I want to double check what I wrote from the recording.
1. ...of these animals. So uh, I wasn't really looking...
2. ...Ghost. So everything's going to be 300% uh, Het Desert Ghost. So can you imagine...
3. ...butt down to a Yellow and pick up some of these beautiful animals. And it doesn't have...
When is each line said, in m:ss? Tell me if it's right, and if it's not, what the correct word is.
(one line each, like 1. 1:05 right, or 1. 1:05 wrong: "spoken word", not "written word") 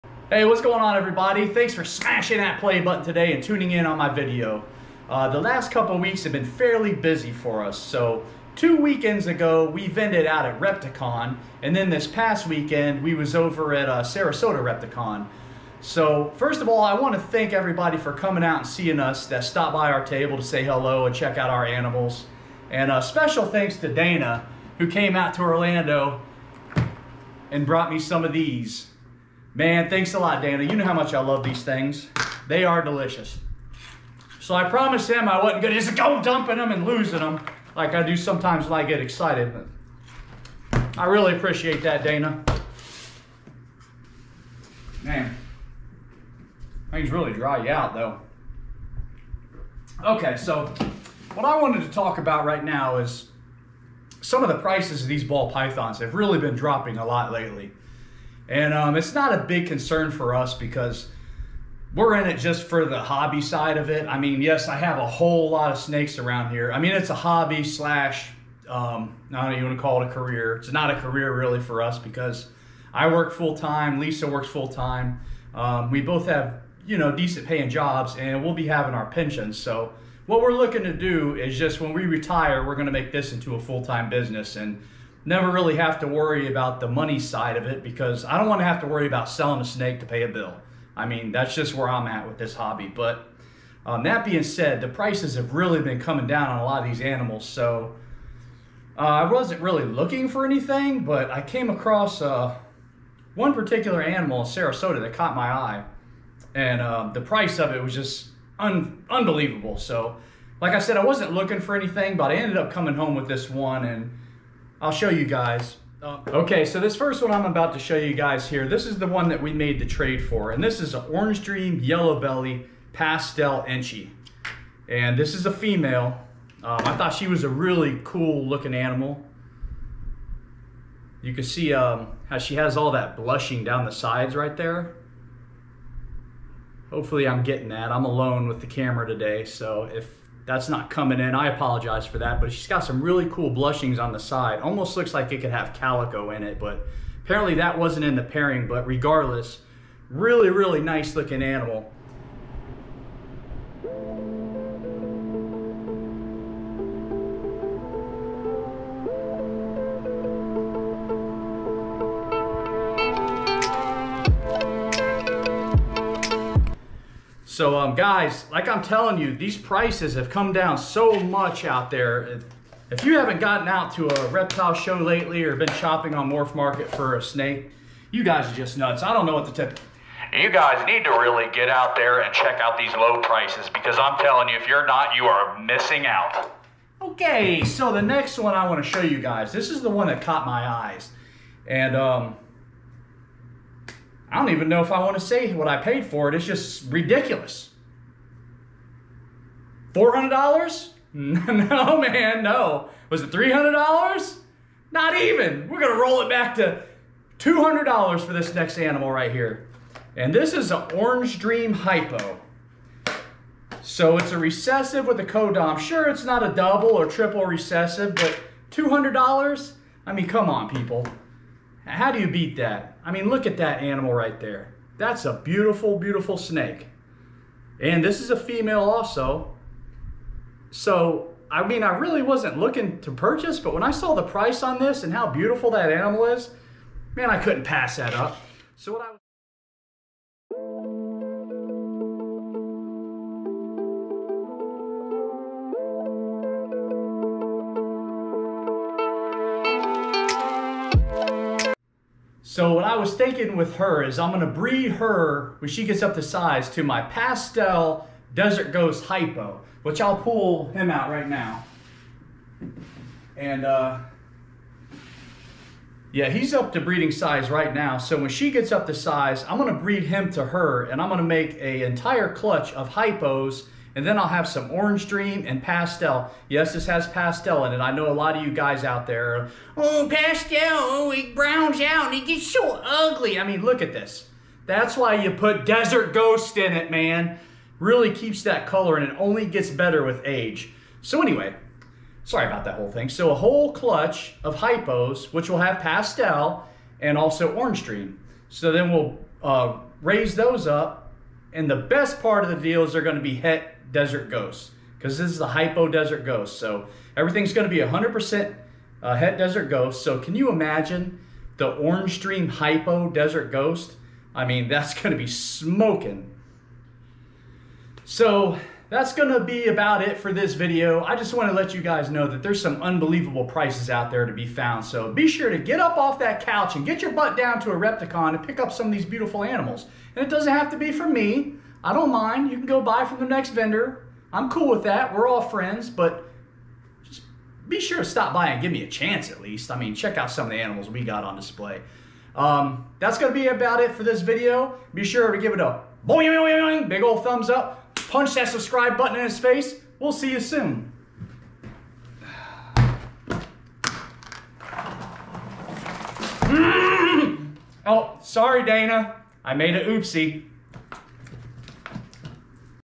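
1. 1:36 right
2. 5:06 wrong: "100", not "300"
3. 5:27 wrong: "Repticon", not "Yellow".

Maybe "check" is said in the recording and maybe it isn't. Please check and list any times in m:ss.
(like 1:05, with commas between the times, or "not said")
0:21, 3:02, 5:39.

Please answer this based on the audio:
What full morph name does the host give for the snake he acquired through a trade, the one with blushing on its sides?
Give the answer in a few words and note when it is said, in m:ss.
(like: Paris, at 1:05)
Orange Dream Yellow Belly Pastel Enchi, at 2:01.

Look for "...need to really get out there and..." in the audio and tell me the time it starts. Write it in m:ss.
3:00.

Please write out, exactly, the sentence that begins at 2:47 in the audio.
So um, guys, like I'm telling you, these prices have come down so much out there.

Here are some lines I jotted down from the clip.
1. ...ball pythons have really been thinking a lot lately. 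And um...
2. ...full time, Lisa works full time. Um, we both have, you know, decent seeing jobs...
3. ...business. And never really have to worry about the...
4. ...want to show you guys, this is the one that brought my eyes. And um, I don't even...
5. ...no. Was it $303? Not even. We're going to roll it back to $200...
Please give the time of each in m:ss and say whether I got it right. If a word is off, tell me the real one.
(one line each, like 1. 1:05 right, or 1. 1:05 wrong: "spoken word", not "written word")
1. 0:55 wrong: "dropping", not "thinking"
2. 1:13 wrong: "paying", not "seeing"
3. 1:24 right
4. 3:08 wrong: "caught", not "brought"
5. 3:22 wrong: "300", not "303".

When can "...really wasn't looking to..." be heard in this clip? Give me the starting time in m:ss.
3:51.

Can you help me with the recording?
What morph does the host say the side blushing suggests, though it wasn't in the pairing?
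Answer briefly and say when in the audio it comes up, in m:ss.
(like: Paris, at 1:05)
calico, at 2:25.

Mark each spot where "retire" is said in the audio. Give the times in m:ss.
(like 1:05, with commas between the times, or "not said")
1:22.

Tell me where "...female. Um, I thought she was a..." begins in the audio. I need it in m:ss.
2:05.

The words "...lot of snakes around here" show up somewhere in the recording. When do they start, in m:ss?
1:05.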